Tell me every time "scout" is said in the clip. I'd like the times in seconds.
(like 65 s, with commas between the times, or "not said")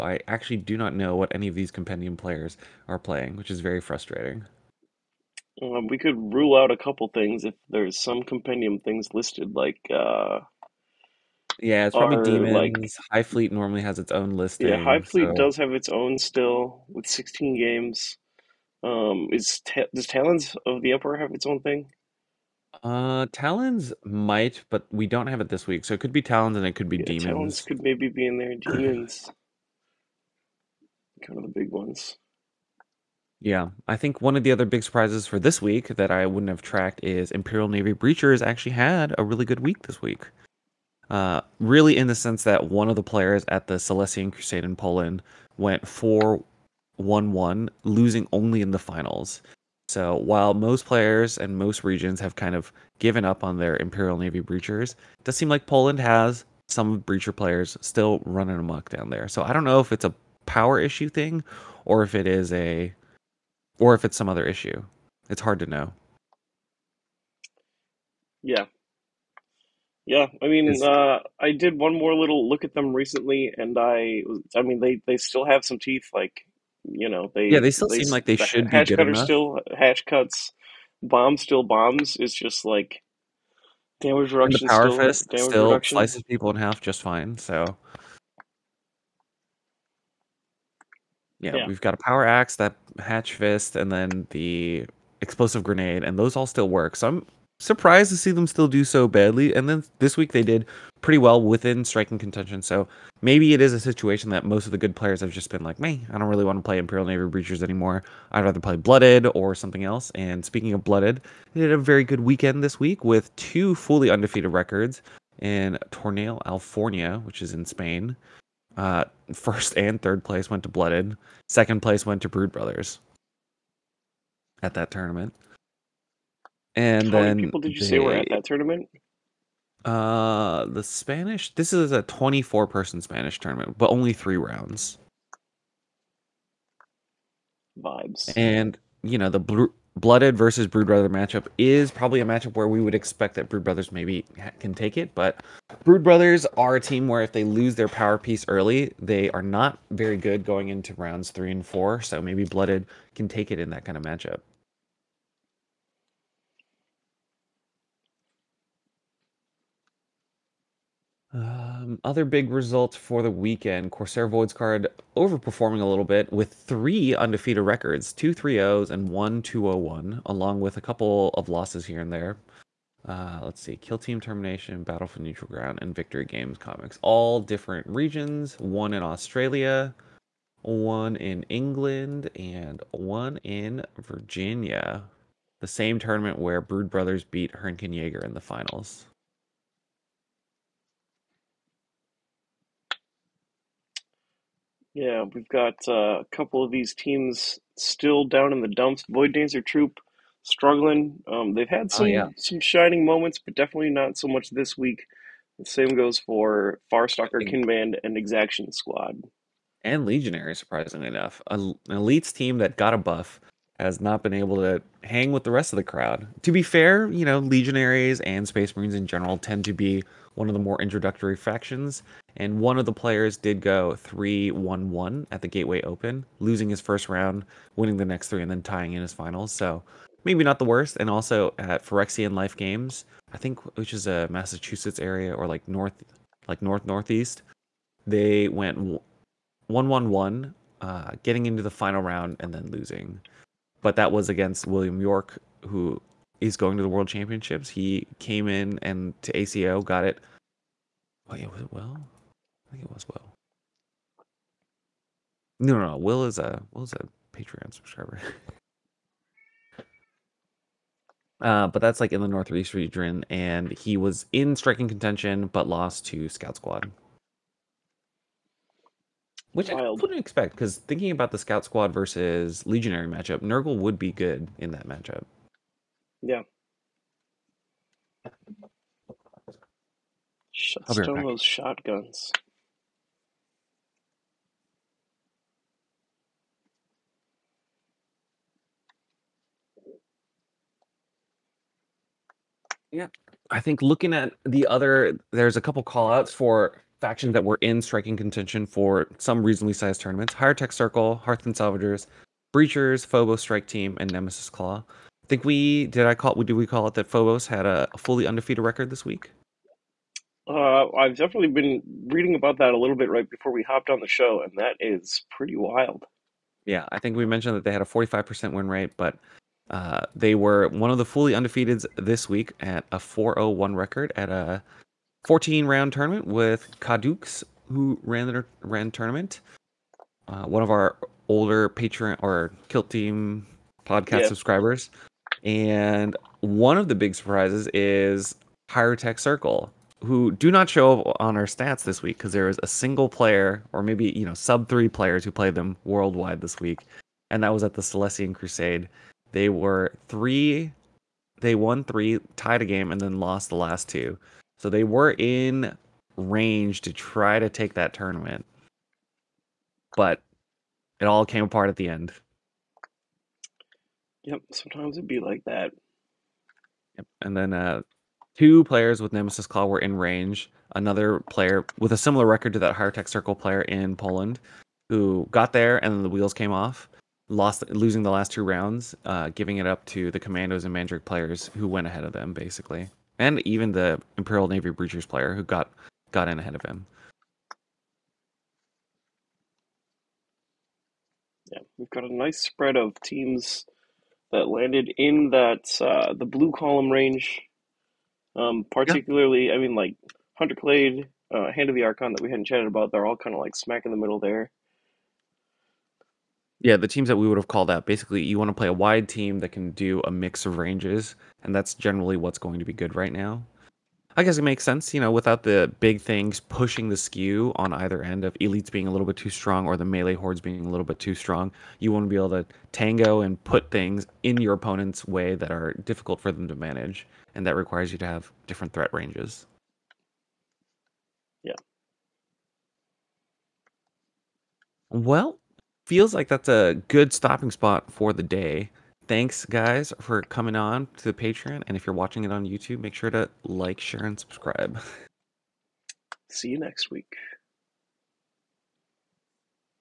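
266 s, 271 s.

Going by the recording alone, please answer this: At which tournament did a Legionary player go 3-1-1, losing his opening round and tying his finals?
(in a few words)
Gateway Open.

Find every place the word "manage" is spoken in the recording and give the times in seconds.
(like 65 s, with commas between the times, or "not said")
426 s.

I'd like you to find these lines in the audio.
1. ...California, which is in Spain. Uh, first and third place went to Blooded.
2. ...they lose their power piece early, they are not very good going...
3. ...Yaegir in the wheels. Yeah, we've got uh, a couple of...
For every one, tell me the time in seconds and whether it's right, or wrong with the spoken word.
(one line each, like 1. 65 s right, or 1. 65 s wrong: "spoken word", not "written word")
1. 116 s right
2. 147 s right
3. 187 s wrong: "finals", not "wheels".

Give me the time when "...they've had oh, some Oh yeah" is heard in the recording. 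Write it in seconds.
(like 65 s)
201 s.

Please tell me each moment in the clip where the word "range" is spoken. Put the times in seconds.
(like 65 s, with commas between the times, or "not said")
356 s, 369 s, 396 s, 410 s, 428 s.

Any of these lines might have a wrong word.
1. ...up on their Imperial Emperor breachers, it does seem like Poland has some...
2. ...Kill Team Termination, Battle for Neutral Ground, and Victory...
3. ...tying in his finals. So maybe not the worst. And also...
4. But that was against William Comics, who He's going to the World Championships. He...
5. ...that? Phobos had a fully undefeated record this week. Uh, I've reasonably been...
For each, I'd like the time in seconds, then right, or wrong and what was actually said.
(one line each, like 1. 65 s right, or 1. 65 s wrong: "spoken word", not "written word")
1. 53 s wrong: "Navy", not "Emperor"
2. 173 s right
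3. 228 s right
4. 243 s wrong: "York", not "Comics"
5. 306 s wrong: "definitely", not "reasonably".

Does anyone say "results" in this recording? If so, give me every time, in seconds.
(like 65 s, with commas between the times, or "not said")
162 s.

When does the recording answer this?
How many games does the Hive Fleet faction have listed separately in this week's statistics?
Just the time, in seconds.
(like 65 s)
17 s.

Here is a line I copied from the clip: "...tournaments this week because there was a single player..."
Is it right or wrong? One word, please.
wrong.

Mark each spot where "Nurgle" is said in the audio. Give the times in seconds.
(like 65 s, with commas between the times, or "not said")
273 s.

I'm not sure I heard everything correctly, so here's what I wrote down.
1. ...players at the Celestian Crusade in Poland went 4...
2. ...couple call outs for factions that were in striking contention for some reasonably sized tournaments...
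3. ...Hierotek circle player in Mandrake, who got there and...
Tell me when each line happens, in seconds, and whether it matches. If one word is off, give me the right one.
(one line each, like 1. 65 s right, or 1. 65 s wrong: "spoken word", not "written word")
1. 43 s right
2. 295 s right
3. 372 s wrong: "Poland", not "Mandrake".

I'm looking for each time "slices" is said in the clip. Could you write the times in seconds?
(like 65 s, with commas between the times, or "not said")
85 s.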